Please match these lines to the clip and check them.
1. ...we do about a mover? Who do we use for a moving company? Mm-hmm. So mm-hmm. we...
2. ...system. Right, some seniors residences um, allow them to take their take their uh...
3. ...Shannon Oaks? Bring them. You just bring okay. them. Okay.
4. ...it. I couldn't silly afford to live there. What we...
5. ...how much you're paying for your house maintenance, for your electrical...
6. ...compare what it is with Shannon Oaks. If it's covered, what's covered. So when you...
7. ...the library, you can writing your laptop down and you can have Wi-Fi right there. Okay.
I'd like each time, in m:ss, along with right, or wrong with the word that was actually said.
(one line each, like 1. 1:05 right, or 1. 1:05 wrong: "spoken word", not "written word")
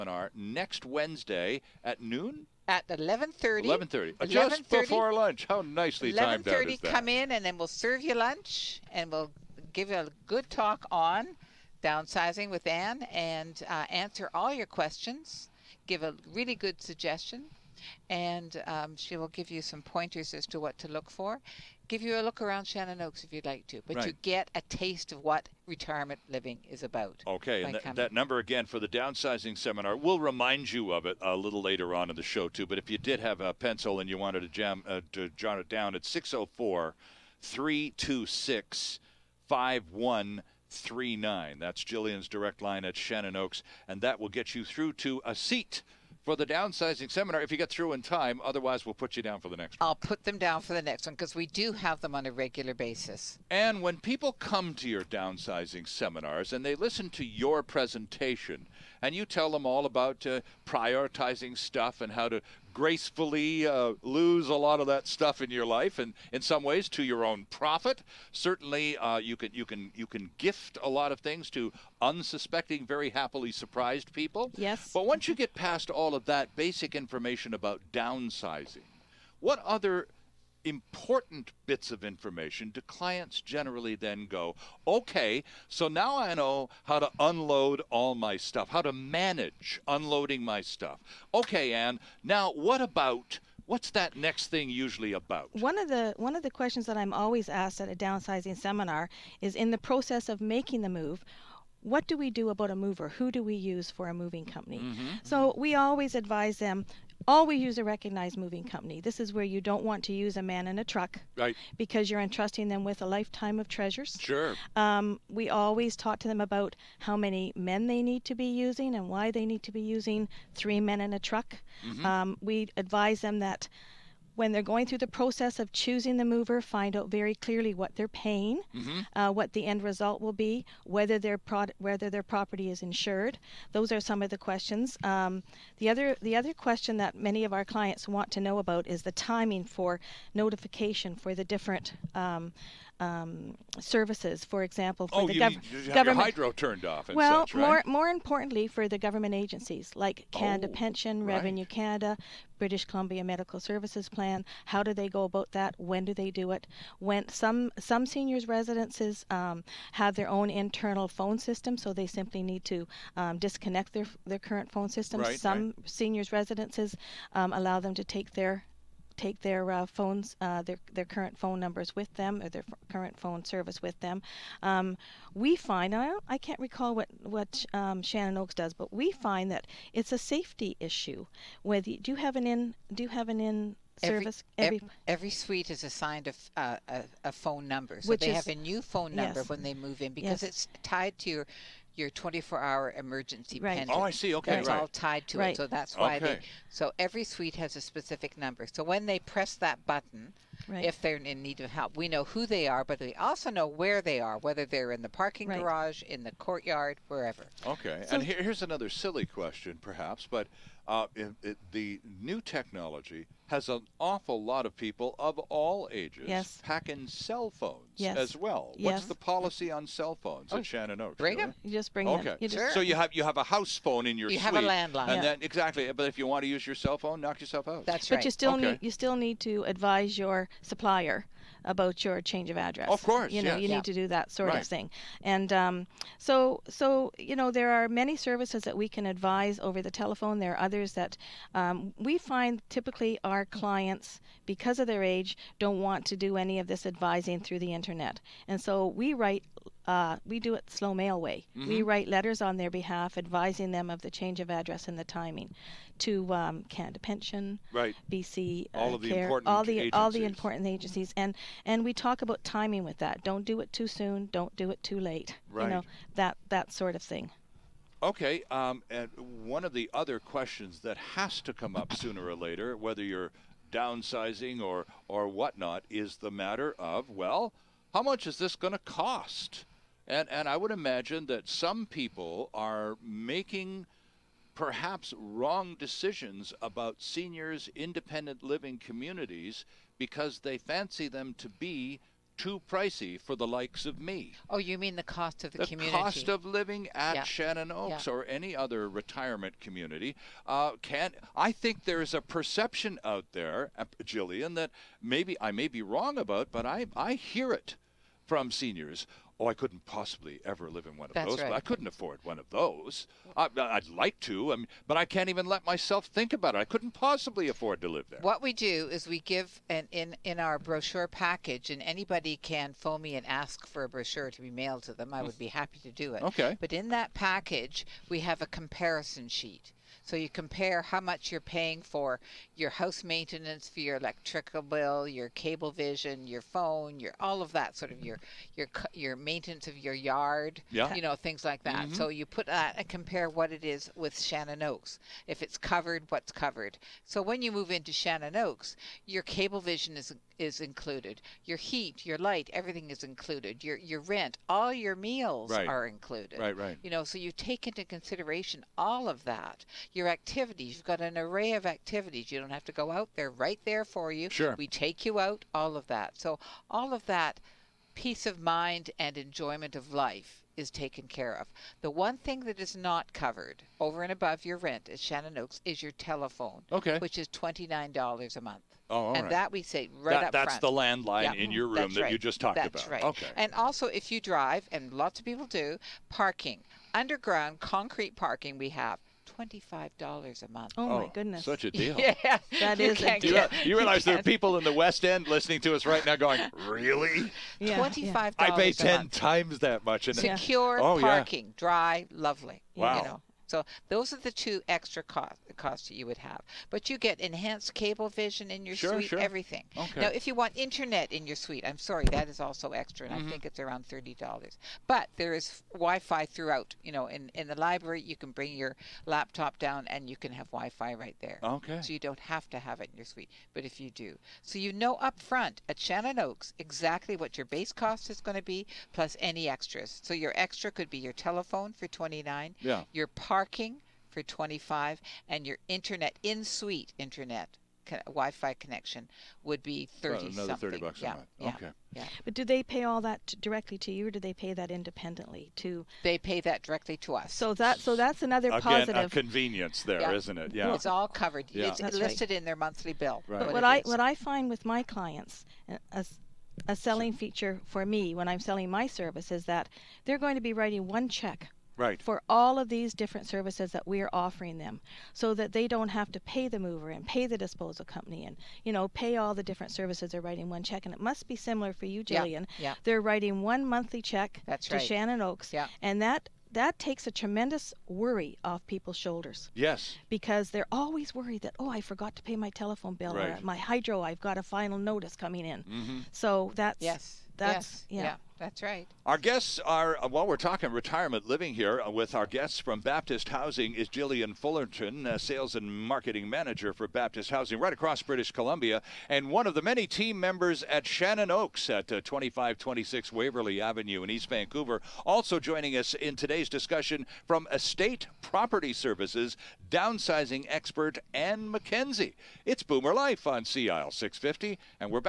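1. 1:42 right
2. 2:44 right
3. 3:40 right
4. 5:16 wrong: "possibly", not "silly"
5. 5:30 right
6. 5:42 right
7. 6:57 wrong: "bring", not "writing".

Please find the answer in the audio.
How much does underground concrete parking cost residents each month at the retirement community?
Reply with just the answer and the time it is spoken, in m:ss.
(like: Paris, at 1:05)
$25, at 6:29.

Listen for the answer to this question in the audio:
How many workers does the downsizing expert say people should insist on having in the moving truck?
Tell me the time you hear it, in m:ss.
2:00.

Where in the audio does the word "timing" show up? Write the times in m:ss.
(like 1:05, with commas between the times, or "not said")
2:19, 4:15, 4:22.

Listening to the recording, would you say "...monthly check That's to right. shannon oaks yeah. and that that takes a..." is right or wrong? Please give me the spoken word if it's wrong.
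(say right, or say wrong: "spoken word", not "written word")
right.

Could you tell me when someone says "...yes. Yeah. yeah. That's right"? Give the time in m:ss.
8:07.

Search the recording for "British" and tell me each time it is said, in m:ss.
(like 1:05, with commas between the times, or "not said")
2:32, 8:18.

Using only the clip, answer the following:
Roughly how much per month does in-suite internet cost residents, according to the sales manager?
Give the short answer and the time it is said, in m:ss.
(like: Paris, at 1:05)
$30, at 6:53.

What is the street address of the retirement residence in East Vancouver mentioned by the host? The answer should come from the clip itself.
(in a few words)
2526 Waverly Avenue.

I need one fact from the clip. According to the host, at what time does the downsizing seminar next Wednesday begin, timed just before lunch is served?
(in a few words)
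11:30.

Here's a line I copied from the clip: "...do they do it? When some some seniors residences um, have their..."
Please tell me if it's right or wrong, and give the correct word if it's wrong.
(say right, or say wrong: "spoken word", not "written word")
right.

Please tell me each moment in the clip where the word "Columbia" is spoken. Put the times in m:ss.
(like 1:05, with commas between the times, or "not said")
2:32, 8:18.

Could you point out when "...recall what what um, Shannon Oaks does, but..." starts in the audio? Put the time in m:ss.
2:56.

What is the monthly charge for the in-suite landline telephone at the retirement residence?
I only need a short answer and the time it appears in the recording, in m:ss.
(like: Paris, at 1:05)
$29, at 6:17.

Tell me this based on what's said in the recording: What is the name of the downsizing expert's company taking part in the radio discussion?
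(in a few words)
Estate Property Services.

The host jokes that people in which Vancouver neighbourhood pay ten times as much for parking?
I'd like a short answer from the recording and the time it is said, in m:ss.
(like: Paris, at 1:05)
West End, at 6:34.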